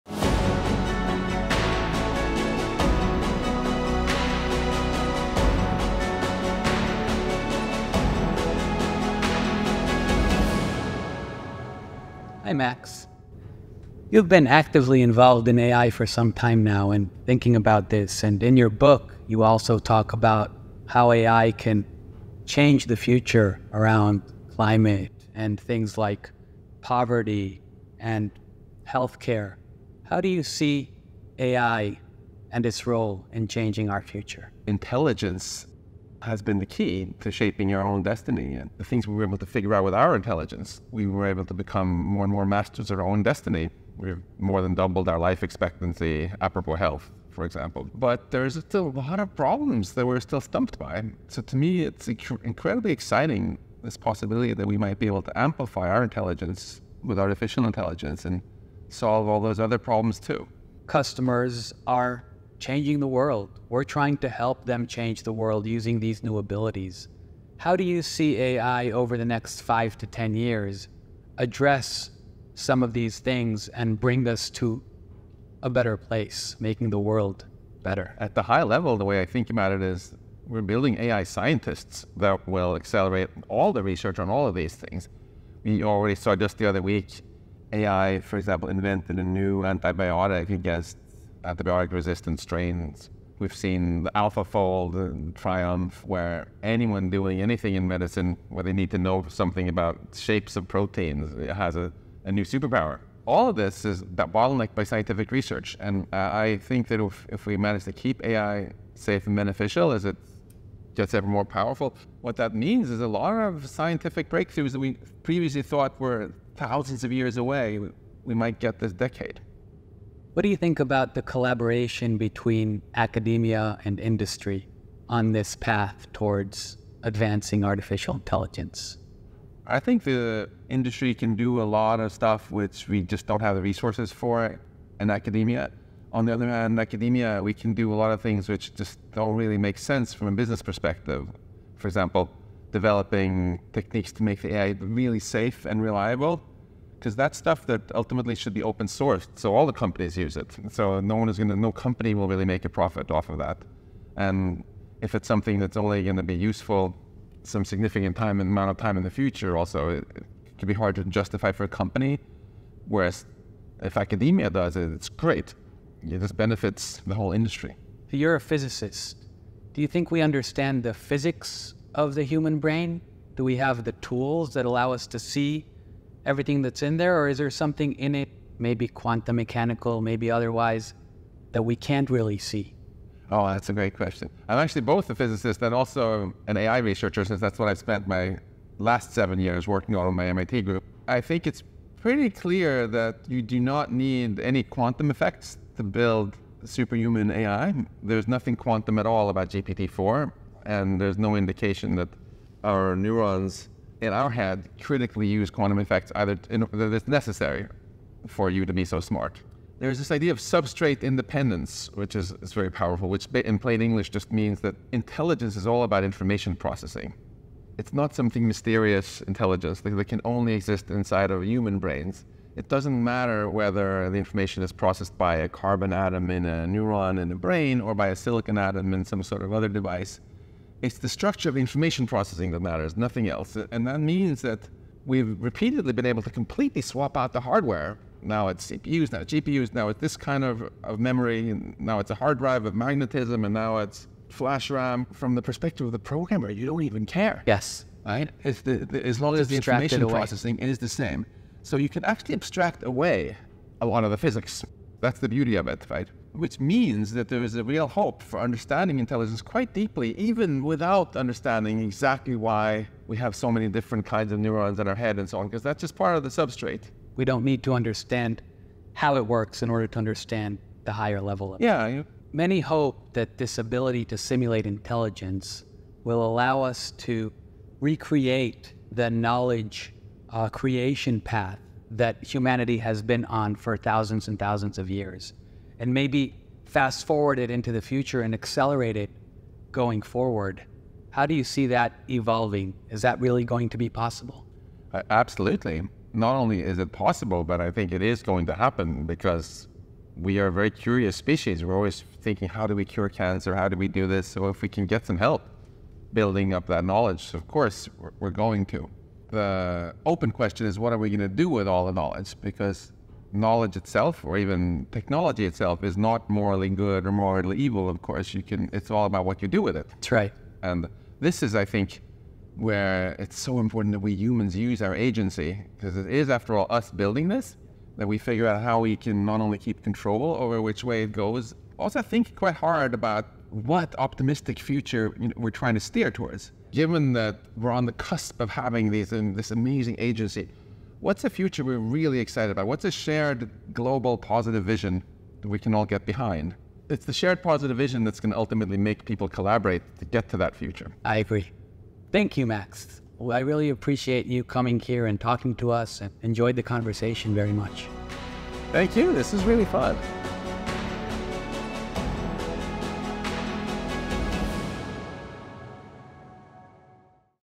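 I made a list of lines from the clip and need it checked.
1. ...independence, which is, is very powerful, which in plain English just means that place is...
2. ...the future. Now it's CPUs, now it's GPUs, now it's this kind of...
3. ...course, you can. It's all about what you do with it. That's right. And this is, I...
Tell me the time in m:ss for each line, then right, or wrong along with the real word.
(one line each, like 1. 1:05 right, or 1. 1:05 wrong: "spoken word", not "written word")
1. 3:31 wrong: "intelligence", not "place"
2. 3:57 wrong: "hardware", not "future"
3. 5:18 right.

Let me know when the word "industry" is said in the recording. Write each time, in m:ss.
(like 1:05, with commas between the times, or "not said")
2:03, 2:10, 2:47.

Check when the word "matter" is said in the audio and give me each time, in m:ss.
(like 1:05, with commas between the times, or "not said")
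3:43, 3:52.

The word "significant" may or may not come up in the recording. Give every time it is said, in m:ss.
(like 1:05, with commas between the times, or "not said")
2:37.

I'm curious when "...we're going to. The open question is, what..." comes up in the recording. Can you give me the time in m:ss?
5:08.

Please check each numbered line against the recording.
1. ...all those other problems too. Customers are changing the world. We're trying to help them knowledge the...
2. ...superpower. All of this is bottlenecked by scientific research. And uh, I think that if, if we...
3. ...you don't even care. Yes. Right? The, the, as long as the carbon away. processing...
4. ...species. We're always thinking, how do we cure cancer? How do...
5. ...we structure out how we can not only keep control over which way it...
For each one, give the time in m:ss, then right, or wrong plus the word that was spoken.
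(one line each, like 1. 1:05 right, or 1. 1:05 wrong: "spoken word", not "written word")
1. 0:59 wrong: "change", not "knowledge"
2. 1:42 right
3. 4:06 wrong: "information", not "carbon"
4. 5:01 right
5. 5:28 wrong: "figure", not "structure".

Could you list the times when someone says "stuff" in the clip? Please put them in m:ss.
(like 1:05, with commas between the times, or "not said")
2:12, 2:27.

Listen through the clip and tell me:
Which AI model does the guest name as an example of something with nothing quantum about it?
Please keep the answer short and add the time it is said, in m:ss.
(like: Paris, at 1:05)
GPT-4, at 3:19.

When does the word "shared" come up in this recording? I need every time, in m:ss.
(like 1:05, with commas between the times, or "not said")
5:42, 5:47.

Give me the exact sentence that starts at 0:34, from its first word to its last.
Intelligence has been the key to shaping our own destiny.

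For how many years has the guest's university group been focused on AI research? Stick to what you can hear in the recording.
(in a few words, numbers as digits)
7.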